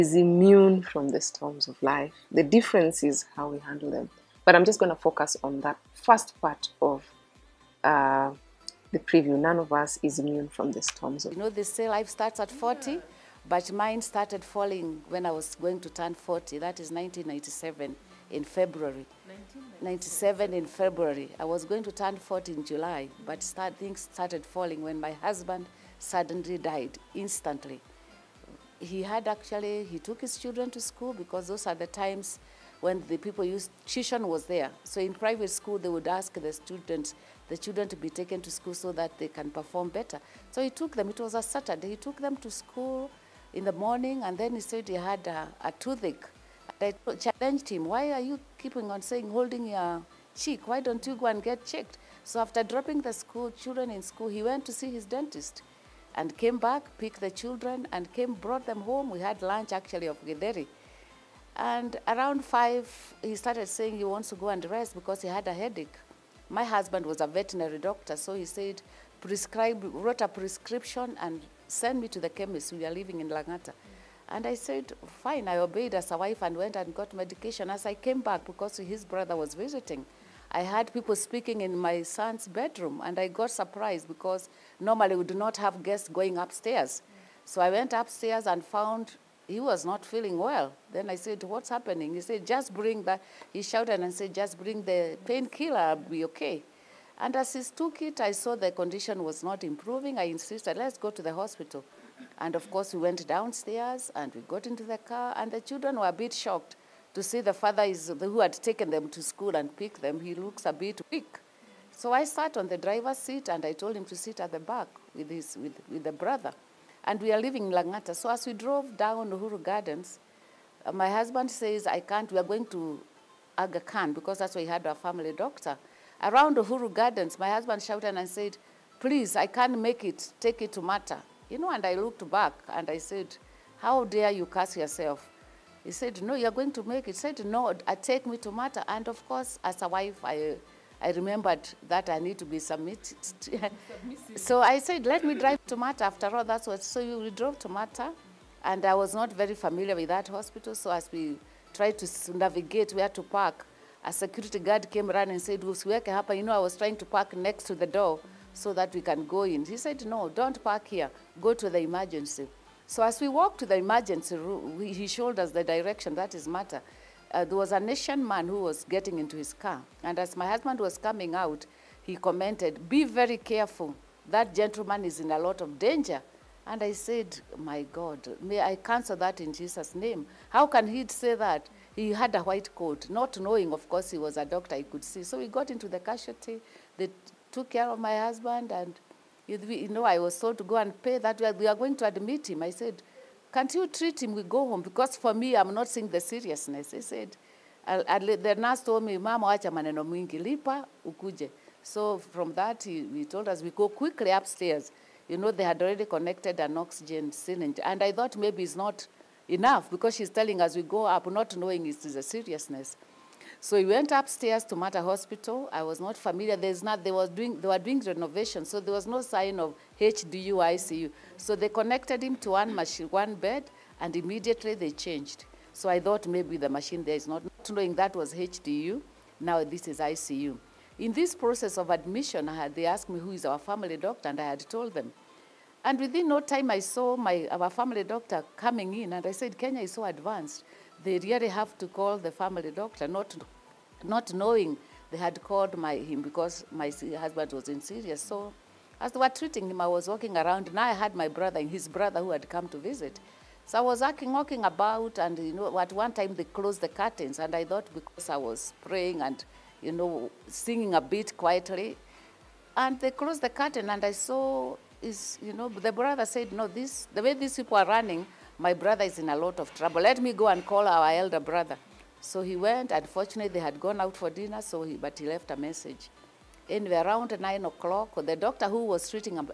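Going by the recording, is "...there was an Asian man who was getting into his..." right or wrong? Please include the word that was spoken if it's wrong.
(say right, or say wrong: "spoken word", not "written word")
right.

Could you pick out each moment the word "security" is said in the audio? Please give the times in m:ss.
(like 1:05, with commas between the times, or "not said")
2:34.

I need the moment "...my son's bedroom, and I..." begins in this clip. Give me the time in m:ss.
1:21.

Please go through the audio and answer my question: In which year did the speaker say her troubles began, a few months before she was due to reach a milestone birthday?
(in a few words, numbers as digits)
1997.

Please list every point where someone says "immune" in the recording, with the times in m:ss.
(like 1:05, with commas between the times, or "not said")
0:00, 0:10.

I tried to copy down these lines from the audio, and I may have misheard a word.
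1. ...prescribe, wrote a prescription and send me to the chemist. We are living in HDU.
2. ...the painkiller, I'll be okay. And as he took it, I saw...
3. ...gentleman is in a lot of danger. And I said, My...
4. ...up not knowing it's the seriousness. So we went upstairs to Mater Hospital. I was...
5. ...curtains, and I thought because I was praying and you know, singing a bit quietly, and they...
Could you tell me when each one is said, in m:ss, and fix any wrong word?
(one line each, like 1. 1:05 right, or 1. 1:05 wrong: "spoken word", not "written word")
1. 1:09 wrong: "Langata", not "HDU"
2. 1:34 right
3. 2:54 right
4. 3:31 right
5. 4:16 right.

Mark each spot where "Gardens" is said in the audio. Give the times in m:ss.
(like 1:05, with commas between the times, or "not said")
1:59, 2:06.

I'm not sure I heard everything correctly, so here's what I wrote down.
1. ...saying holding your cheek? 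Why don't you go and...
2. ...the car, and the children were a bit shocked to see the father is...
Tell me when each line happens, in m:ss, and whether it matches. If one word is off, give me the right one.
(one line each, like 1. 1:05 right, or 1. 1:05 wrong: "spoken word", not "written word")
1. 0:49 right
2. 1:44 right.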